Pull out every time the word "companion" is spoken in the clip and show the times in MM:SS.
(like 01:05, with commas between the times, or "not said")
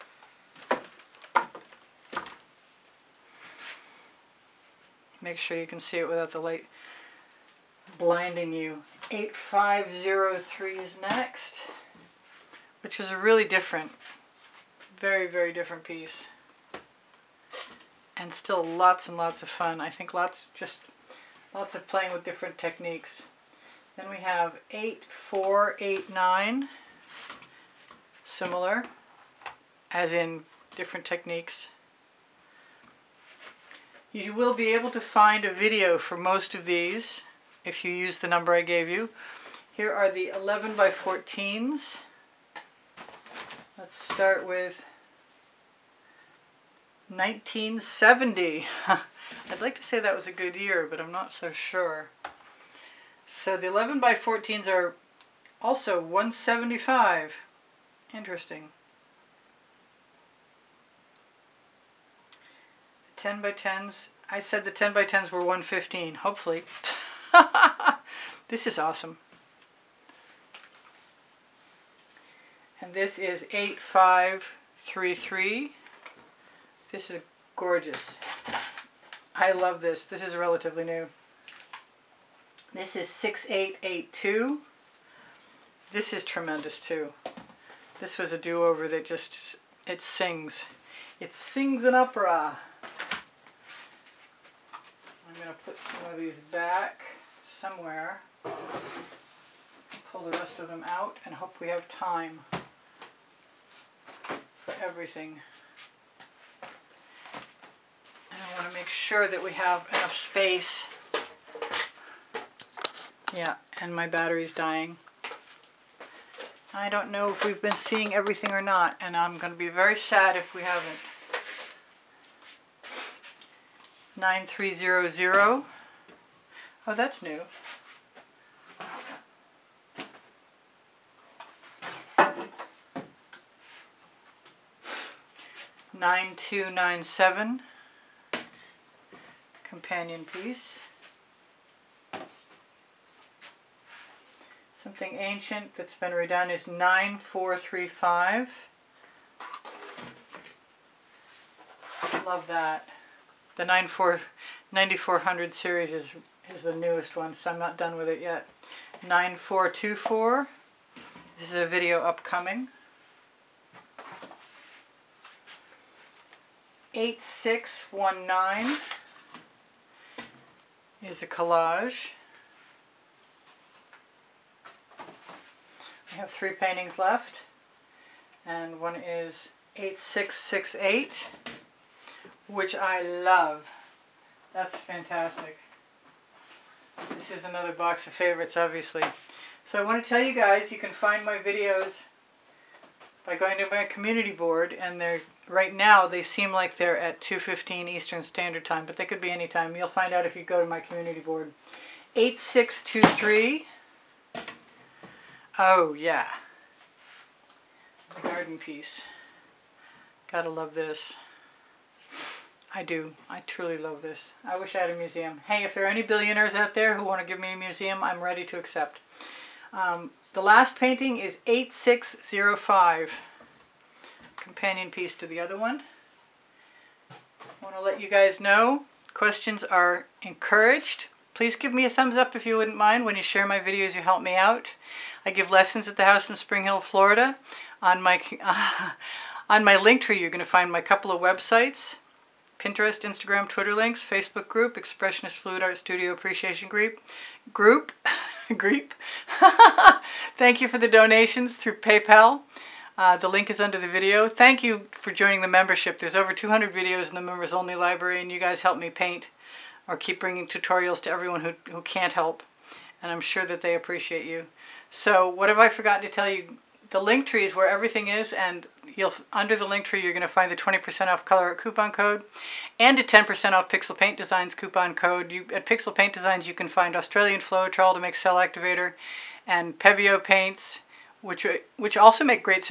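02:19, 03:44.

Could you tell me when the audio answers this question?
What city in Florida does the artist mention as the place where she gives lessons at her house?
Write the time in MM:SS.
03:56.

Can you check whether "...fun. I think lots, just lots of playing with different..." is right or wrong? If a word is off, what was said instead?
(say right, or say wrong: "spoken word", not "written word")
right.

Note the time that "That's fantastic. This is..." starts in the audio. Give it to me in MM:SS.
03:04.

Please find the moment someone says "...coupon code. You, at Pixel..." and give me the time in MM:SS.
04:34.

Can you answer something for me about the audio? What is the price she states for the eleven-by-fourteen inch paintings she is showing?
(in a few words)
175.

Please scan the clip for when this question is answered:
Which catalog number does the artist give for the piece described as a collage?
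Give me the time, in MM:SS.
02:46.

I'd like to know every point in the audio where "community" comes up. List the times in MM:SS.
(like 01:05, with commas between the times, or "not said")
03:13, 03:20.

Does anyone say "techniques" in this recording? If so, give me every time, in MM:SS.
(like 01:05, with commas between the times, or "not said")
00:22, 00:31.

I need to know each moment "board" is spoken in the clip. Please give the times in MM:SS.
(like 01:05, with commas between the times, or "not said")
03:14, 03:21.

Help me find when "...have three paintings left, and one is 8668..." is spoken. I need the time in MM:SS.
02:56.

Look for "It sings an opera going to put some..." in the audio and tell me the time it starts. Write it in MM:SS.
01:31.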